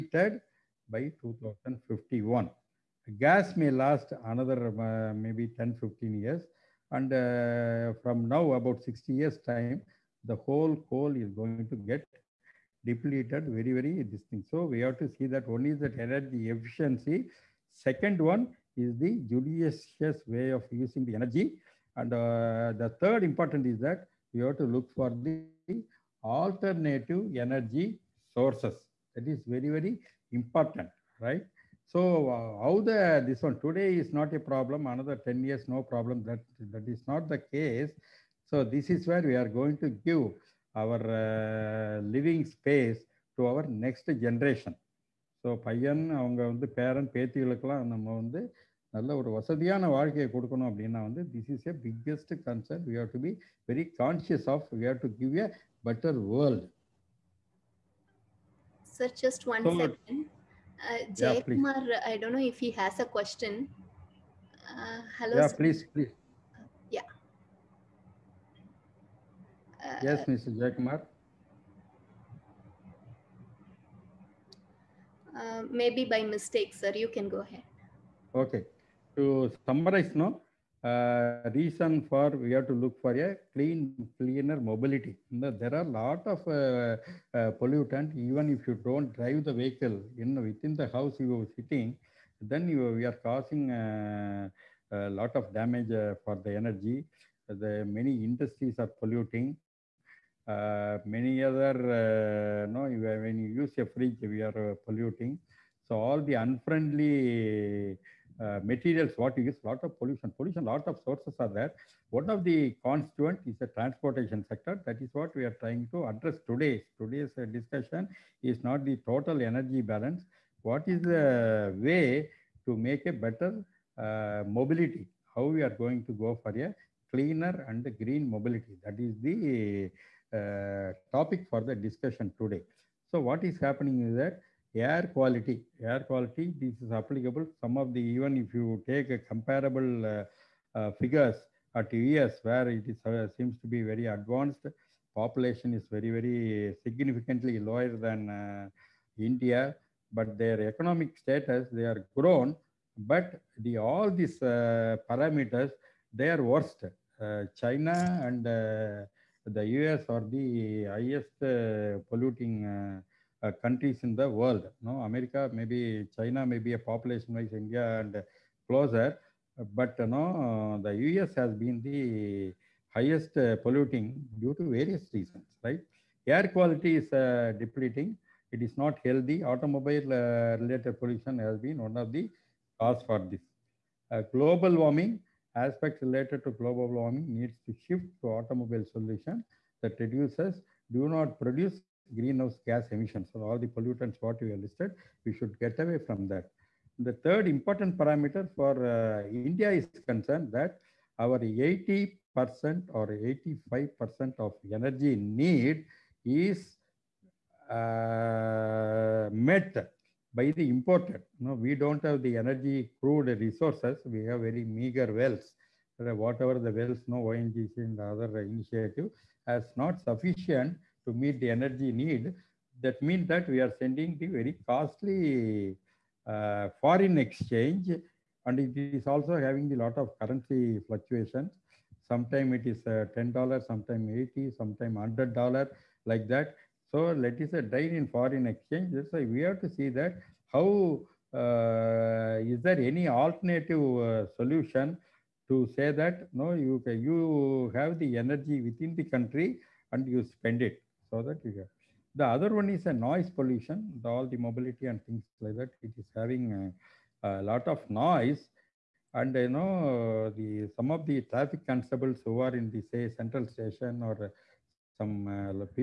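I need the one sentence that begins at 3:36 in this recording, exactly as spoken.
Uh, whatever the wells, no ONGC and the other initiative has not sufficient to meet the energy need.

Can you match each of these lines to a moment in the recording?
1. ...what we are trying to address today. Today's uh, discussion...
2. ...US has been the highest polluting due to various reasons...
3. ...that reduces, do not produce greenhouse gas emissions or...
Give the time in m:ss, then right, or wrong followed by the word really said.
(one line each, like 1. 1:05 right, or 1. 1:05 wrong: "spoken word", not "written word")
1. 1:55 right
2. 2:50 right
3. 3:09 right.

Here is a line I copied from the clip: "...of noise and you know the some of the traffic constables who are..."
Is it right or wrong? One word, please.
right.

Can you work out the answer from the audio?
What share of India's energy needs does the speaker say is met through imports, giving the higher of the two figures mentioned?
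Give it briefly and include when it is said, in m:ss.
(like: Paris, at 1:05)
85%, at 3:23.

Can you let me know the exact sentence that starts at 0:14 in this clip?
So we have to see that one is that energy efficiency.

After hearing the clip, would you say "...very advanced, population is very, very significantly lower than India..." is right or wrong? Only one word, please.
right.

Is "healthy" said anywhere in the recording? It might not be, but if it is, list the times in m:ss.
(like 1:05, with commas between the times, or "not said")
2:59.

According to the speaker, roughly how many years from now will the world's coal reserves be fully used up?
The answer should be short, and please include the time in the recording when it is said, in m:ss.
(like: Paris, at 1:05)
60 years, at 0:08.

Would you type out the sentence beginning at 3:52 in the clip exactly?
Sometimes it is uh, $10, sometimes 80, sometimes $100 like that.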